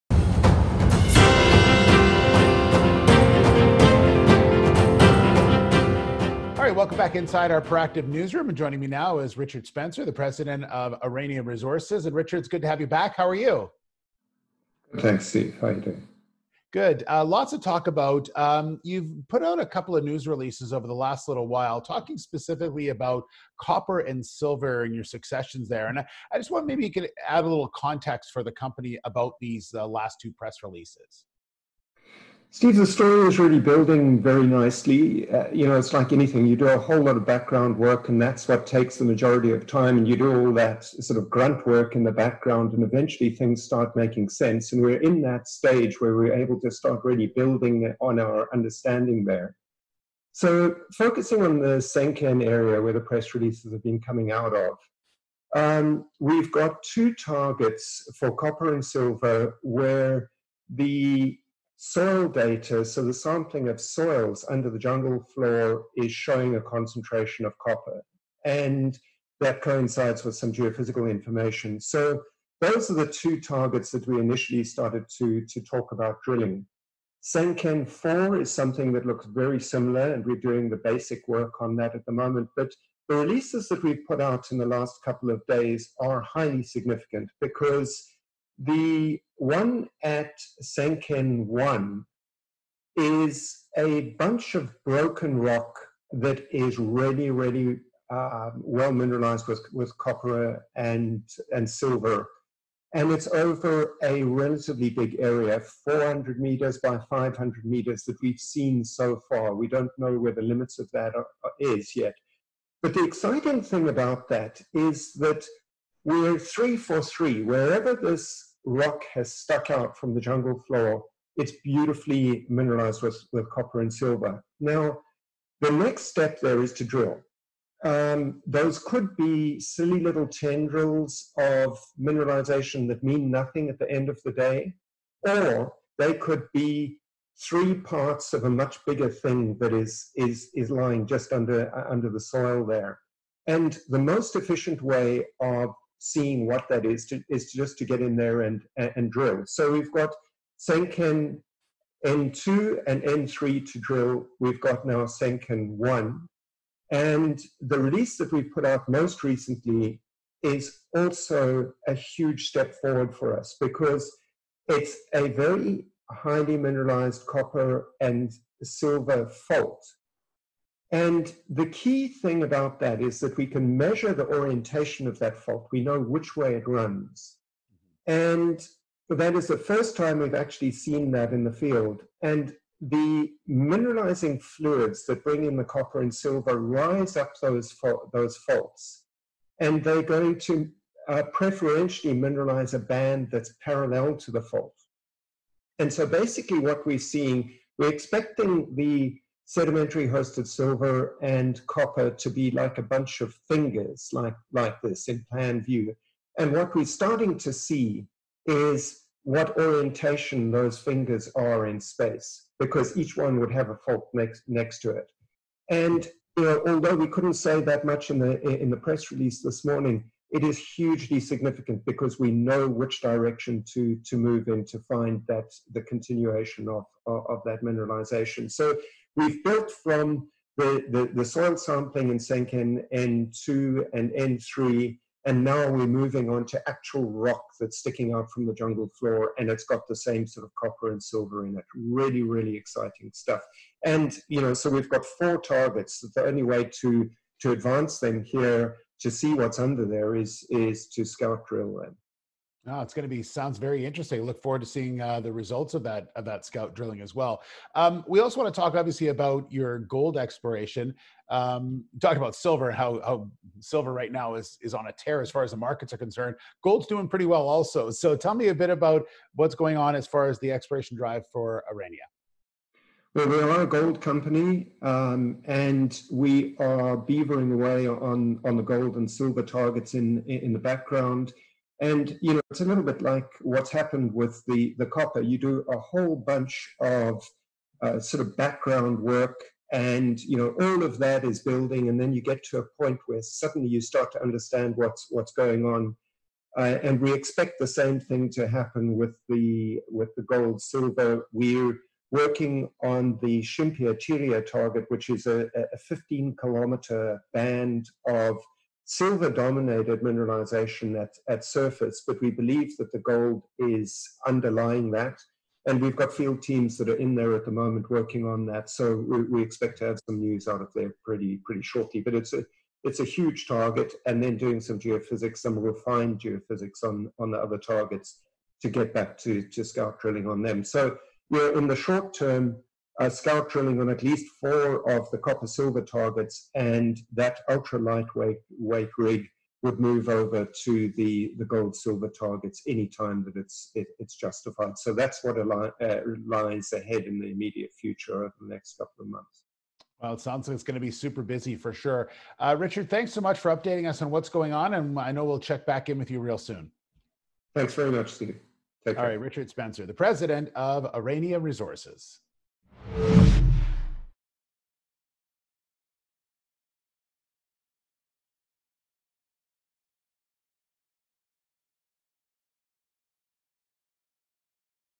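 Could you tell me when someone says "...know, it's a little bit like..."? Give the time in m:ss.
4:42.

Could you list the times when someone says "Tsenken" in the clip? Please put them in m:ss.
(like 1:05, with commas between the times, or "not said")
0:51, 1:17, 1:30, 2:30, 2:35, 3:52.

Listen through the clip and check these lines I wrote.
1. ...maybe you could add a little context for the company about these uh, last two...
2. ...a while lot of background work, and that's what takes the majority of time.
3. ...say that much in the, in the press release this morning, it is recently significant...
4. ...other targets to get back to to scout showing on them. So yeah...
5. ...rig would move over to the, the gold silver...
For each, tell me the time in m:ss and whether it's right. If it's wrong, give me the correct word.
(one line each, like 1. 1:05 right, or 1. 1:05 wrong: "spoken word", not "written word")
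1. 0:26 right
2. 0:36 wrong: "whole", not "while"
3. 3:37 wrong: "hugely", not "recently"
4. 5:27 wrong: "drilling", not "showing"
5. 5:38 right.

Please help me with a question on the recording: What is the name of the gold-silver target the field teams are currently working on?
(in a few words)
Shimpia Tiria.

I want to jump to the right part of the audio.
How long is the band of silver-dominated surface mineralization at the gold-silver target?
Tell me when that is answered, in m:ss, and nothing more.
5:05.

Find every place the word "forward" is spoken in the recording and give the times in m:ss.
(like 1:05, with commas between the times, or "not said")
2:42, 4:14.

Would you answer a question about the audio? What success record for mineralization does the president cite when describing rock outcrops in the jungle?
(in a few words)
three for three.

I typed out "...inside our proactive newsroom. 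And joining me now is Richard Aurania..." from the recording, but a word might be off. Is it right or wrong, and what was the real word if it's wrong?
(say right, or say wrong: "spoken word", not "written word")
wrong: "Spencer", not "Aurania".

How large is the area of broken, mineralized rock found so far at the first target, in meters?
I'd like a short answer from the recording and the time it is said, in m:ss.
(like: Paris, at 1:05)
400 meters by 500 meters, at 1:45.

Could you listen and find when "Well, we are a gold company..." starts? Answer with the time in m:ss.
4:33.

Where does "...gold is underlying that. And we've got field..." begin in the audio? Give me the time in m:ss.
5:12.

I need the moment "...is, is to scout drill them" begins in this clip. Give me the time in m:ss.
4:10.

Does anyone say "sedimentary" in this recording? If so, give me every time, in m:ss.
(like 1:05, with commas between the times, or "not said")
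3:19.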